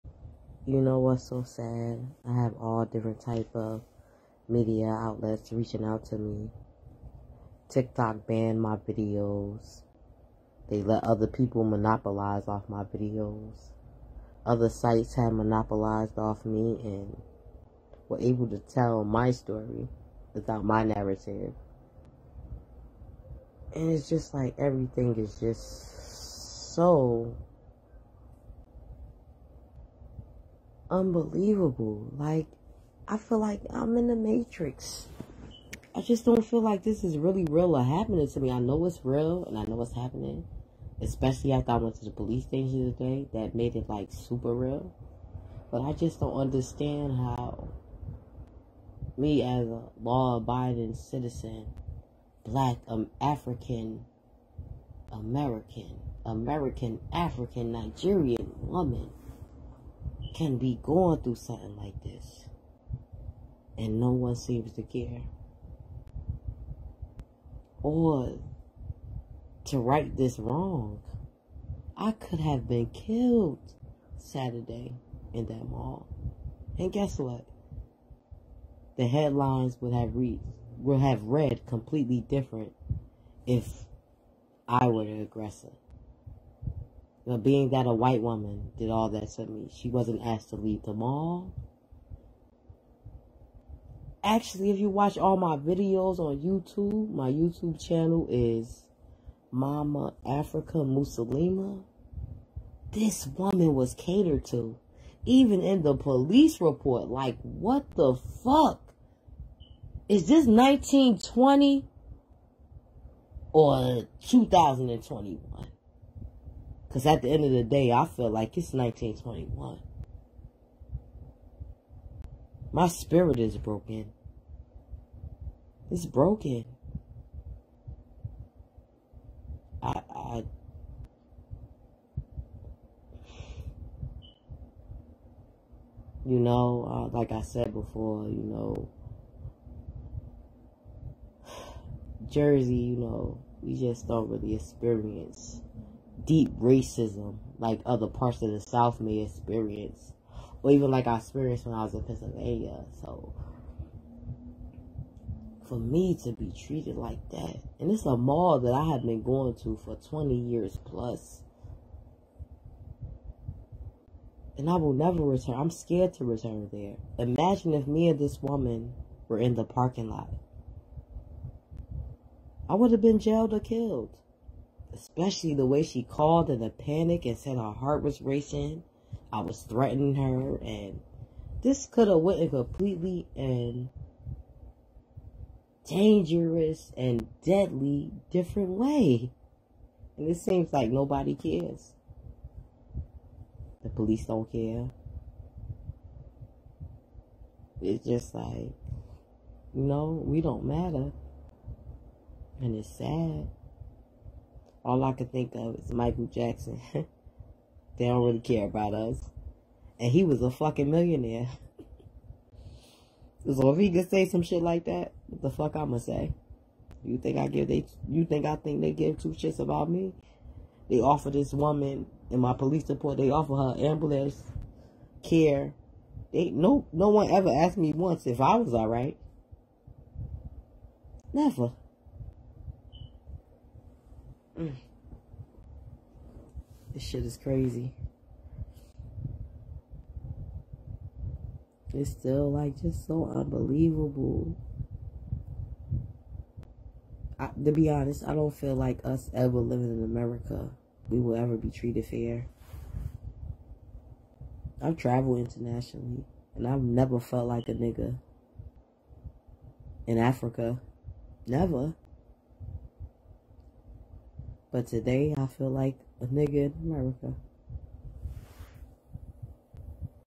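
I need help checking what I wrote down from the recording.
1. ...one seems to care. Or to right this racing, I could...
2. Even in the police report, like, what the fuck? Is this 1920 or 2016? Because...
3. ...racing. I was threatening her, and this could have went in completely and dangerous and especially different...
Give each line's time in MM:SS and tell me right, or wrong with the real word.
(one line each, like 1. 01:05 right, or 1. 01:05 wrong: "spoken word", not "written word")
1. 01:04 wrong: "wrong", not "racing"
2. 01:45 wrong: "2021", not "2016"
3. 02:58 wrong: "deadly", not "especially".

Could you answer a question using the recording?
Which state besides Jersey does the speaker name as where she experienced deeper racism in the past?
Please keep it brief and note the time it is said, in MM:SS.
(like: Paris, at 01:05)
Pennsylvania, at 02:32.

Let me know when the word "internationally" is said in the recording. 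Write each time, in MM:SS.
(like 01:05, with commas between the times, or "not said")
04:15.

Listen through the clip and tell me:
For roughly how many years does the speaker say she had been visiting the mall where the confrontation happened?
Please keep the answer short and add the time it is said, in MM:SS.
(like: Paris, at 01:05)
20 years plus, at 02:39.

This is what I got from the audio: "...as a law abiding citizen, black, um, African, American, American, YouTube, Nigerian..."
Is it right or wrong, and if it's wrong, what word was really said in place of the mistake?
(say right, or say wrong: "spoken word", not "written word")
wrong: "African", not "YouTube".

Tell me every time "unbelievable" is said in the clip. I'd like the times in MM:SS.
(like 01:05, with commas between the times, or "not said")
00:30, 04:03.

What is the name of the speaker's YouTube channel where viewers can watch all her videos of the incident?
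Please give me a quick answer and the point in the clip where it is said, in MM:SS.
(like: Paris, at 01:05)
Mama Africa Musalima, at 01:39.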